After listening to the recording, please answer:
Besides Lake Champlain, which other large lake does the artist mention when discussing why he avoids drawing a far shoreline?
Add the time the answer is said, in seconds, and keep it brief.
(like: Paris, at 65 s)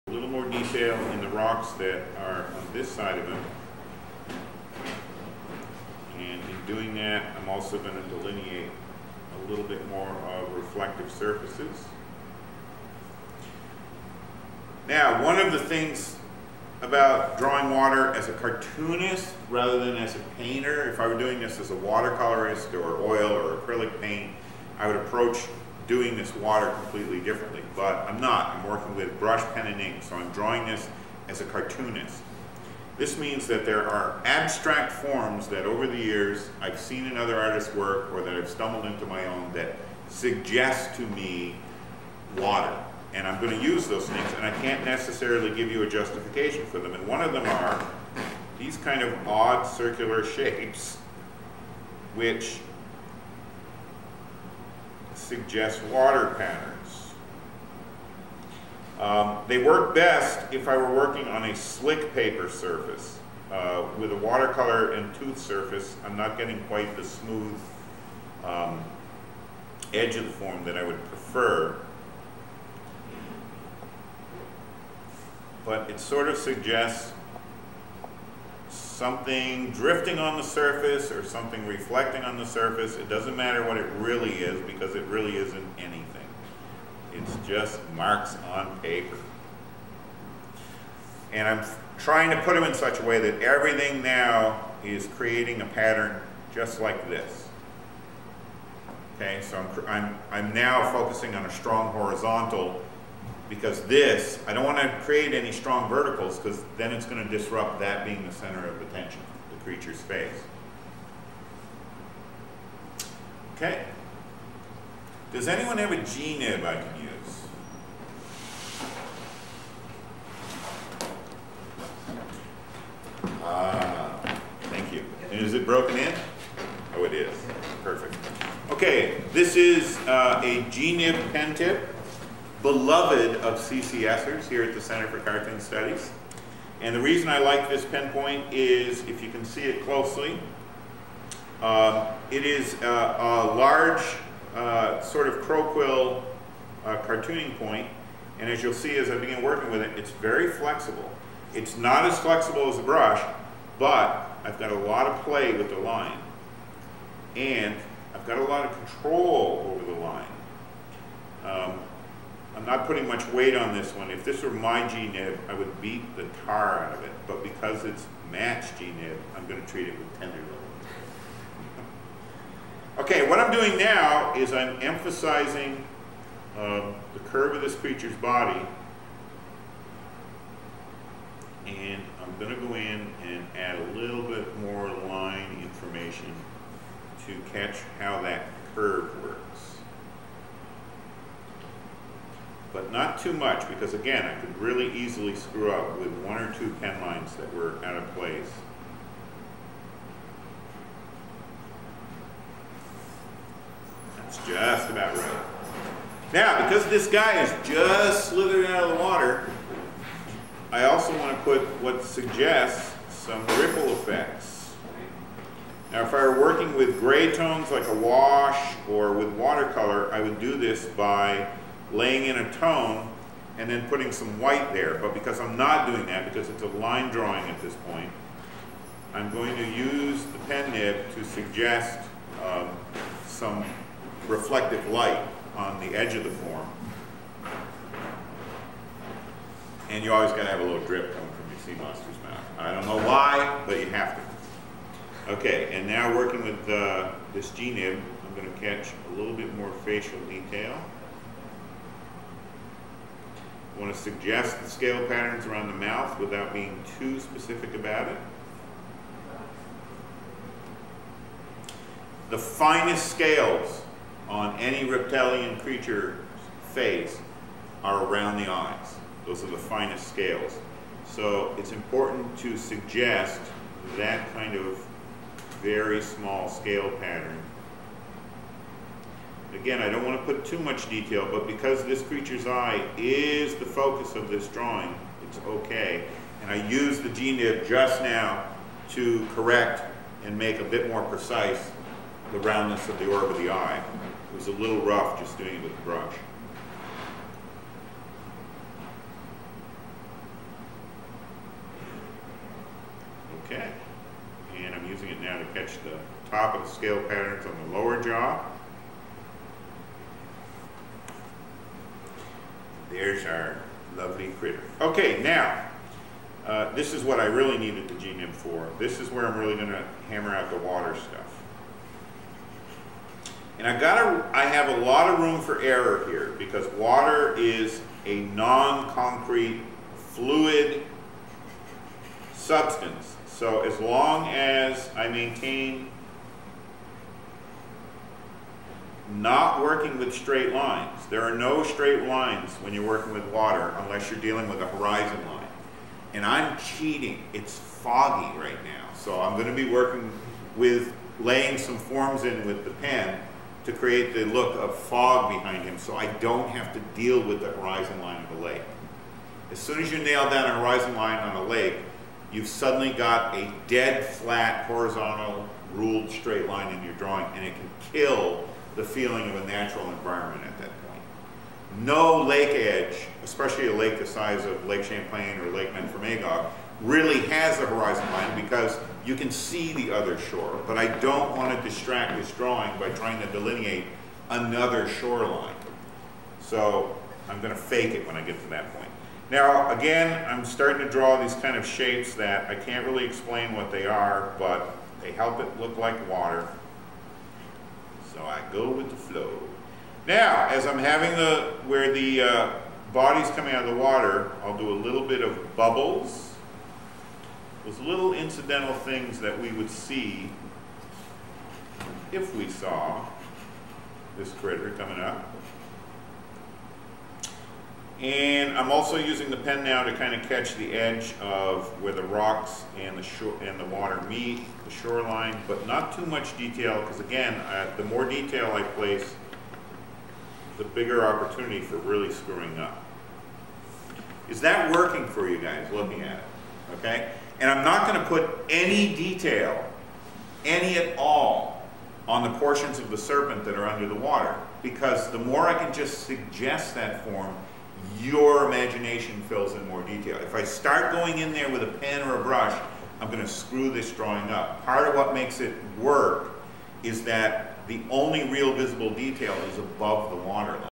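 Lake Memphremagog, at 375 s.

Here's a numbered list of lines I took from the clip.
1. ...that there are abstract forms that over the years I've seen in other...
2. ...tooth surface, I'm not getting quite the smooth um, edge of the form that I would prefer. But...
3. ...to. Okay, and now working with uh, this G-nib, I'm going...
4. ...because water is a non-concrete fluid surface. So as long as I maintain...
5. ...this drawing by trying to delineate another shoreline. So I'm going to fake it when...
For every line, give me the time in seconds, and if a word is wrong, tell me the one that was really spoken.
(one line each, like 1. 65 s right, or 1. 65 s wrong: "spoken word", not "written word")
1. 33 s right
2. 65 s right
3. 244 s right
4. 326 s wrong: "substance", not "surface"
5. 382 s right.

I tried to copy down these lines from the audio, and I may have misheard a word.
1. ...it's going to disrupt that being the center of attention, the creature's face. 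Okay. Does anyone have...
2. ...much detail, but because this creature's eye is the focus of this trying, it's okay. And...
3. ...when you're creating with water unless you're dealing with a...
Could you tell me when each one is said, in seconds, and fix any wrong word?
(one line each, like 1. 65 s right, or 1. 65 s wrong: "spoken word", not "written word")
1. 106 s right
2. 280 s wrong: "drawing", not "trying"
3. 342 s wrong: "working", not "creating".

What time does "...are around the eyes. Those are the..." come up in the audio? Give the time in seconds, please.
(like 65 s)
267 s.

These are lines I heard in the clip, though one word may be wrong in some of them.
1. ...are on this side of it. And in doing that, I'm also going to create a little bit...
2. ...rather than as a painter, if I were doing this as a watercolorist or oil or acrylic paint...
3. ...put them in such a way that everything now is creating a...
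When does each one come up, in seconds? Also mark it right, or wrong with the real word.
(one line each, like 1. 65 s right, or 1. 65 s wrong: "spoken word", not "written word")
1. 2 s wrong: "delineate", not "create"
2. 19 s right
3. 92 s right.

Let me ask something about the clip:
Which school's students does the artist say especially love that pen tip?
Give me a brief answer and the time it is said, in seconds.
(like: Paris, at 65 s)
Center for Cartoon Studies, at 134 s.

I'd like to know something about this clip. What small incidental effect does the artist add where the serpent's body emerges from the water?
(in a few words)
Bubbles.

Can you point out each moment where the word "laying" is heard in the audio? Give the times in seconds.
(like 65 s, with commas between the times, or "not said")
221 s, 351 s.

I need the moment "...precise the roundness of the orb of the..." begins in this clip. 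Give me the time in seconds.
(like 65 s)
291 s.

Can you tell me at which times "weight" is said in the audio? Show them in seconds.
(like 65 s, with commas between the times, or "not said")
163 s.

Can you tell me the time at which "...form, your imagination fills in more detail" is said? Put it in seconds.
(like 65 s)
447 s.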